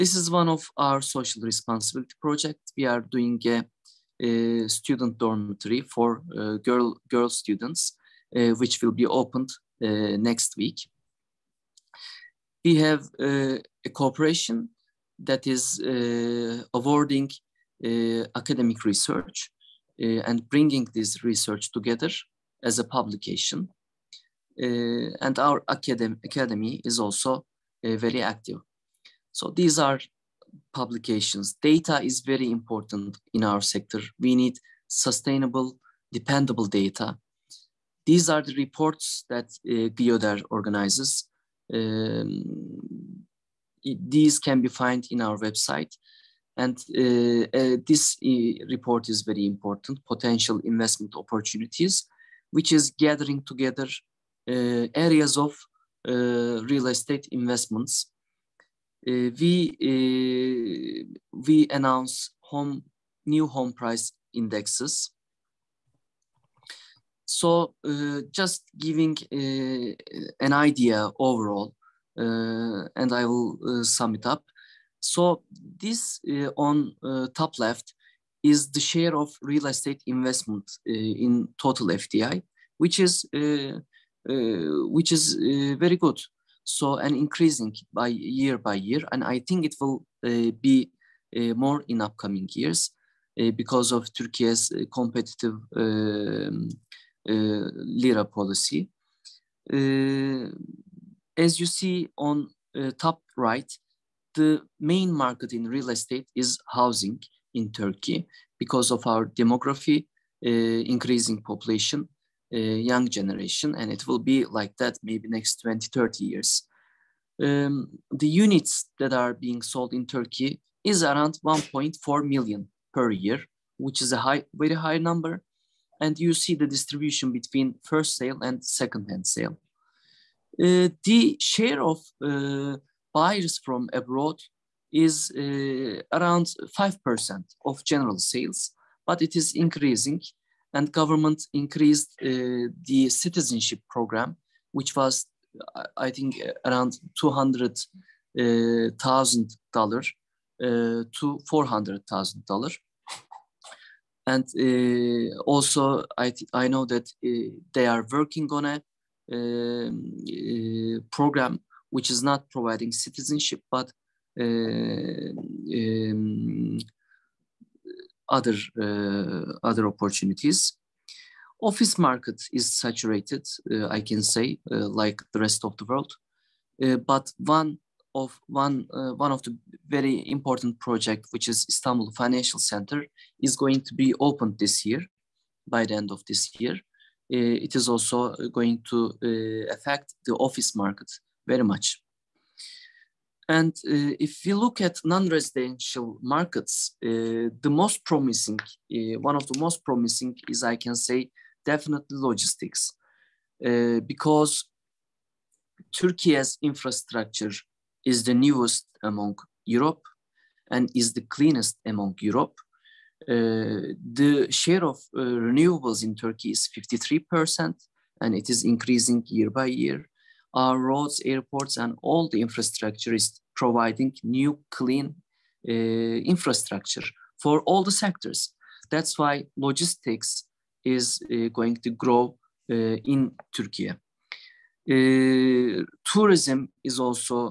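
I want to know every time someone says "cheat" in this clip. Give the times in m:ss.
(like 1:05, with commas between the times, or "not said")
not said.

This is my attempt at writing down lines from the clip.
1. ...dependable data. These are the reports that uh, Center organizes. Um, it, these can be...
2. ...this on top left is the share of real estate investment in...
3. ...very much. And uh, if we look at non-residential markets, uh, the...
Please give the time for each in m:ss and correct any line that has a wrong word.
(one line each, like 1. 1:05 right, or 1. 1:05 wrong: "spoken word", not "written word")
1. 0:36 wrong: "GYODER", not "Center"
2. 1:15 right
3. 3:11 right.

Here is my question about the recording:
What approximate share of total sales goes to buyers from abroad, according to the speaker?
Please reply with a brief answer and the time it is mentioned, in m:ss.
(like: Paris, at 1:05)
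5%, at 2:16.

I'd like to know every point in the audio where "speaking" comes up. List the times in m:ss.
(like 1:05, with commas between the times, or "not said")
not said.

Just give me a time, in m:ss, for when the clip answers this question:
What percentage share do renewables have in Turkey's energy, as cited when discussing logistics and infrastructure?
3:36.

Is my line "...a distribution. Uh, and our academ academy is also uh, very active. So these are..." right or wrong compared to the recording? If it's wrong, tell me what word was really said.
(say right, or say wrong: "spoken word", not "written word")
wrong: "publication", not "distribution".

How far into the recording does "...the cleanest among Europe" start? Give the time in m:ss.
3:31.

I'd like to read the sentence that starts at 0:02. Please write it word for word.
We are doing a uh, student dormitory for uh, girl, girl students, uh, which will be opened next week.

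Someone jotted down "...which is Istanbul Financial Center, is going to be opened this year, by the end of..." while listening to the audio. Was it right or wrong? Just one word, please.
right.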